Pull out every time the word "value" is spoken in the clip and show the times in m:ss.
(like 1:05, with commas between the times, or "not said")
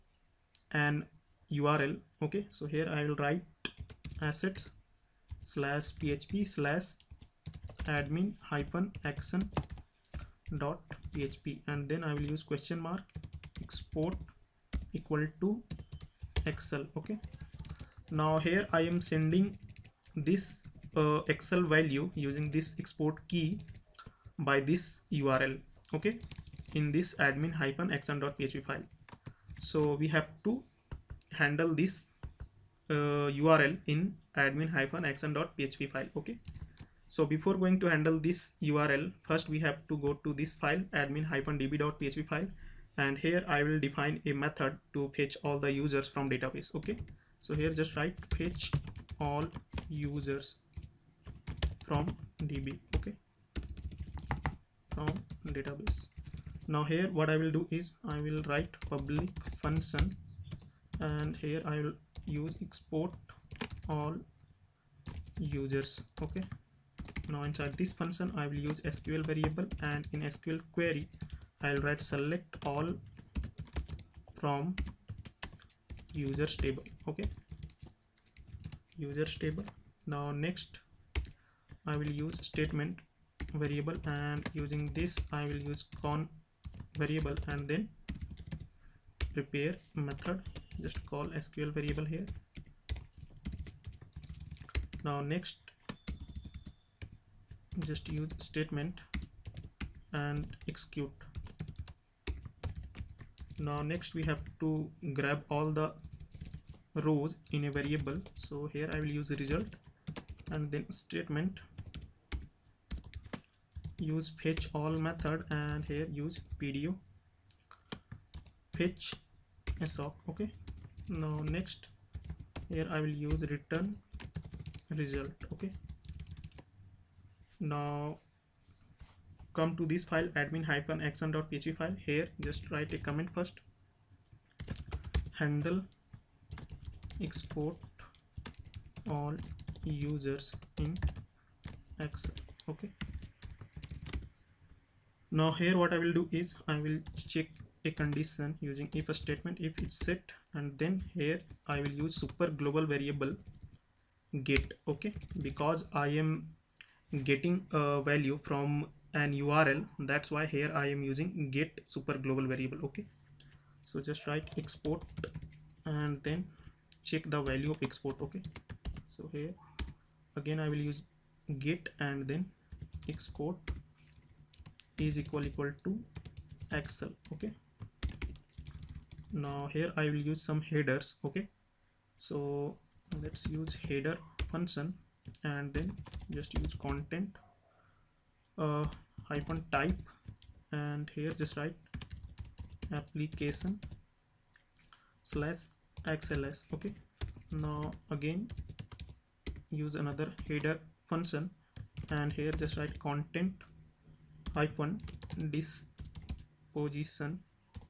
0:21, 2:38, 2:47.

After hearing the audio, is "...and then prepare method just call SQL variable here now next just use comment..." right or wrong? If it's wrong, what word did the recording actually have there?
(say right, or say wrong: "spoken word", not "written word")
wrong: "statement", not "comment".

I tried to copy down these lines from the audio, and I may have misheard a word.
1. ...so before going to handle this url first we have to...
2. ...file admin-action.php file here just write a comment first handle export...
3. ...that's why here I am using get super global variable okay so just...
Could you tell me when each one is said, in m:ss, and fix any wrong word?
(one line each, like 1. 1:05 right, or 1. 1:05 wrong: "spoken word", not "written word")
1. 0:37 right
2. 2:10 right
3. 2:40 right.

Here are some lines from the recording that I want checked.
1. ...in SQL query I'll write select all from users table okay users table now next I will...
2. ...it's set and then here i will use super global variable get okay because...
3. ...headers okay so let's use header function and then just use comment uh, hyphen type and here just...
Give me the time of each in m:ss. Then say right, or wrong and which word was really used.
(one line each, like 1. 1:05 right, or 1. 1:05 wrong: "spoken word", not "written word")
1. 1:10 right
2. 2:29 right
3. 3:00 wrong: "content", not "comment".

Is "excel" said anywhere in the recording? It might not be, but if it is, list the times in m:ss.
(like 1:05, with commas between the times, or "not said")
0:16, 0:21, 2:22, 2:56.